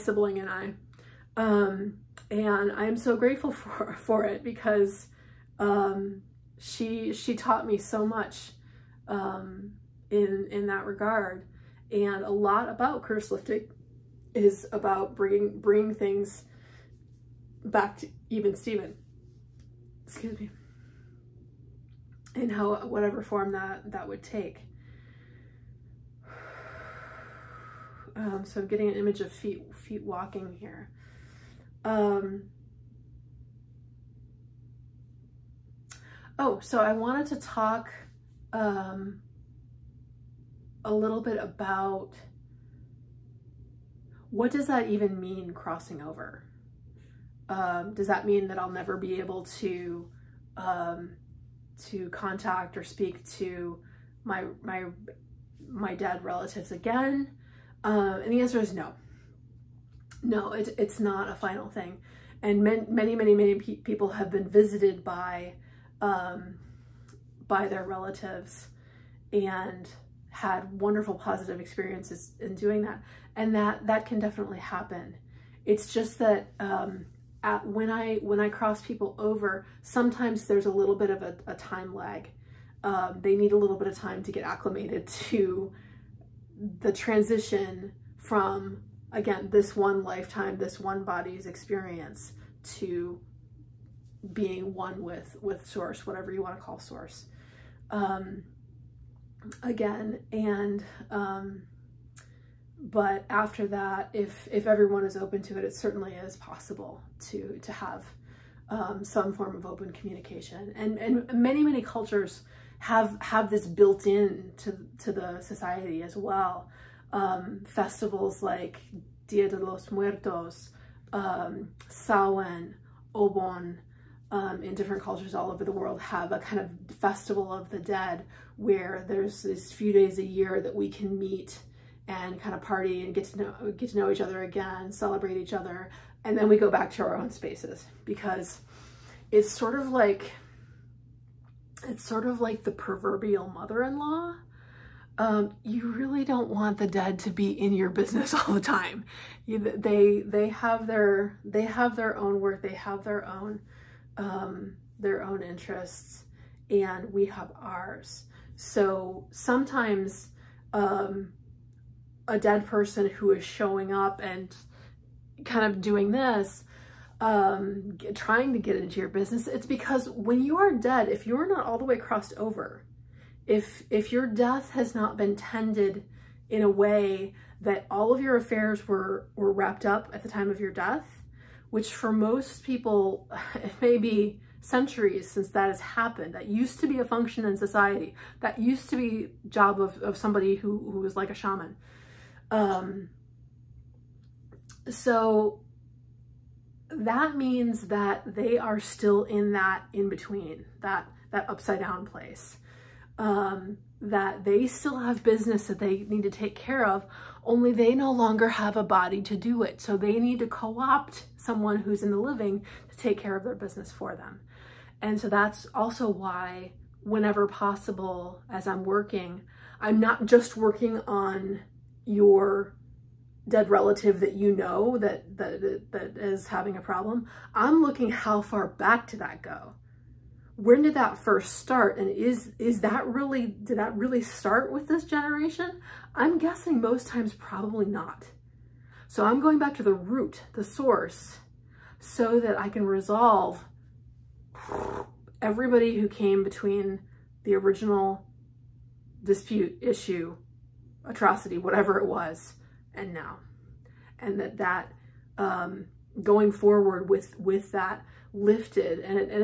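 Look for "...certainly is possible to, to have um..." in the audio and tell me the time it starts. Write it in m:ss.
1:45.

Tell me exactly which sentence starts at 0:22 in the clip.
And how whatever form that that would take.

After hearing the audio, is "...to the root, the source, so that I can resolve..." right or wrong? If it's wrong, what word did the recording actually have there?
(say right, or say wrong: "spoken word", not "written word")
right.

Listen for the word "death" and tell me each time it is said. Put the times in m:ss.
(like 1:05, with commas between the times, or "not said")
2:54, 3:00.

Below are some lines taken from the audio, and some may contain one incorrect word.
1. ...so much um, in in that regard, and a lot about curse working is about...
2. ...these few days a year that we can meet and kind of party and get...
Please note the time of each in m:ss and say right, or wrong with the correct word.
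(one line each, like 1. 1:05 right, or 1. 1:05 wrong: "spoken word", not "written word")
1. 0:07 wrong: "lifting", not "working"
2. 2:09 right.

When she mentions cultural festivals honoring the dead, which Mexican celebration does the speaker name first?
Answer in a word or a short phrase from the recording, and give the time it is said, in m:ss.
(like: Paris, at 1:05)
Dia de los Muertos, at 1:59.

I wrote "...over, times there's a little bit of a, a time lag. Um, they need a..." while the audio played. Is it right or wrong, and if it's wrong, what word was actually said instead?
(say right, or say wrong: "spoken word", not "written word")
wrong: "sometimes", not "times".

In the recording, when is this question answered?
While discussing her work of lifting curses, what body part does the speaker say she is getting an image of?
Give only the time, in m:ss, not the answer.
0:29.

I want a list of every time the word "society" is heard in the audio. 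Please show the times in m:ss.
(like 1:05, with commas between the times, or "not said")
1:55, 3:07.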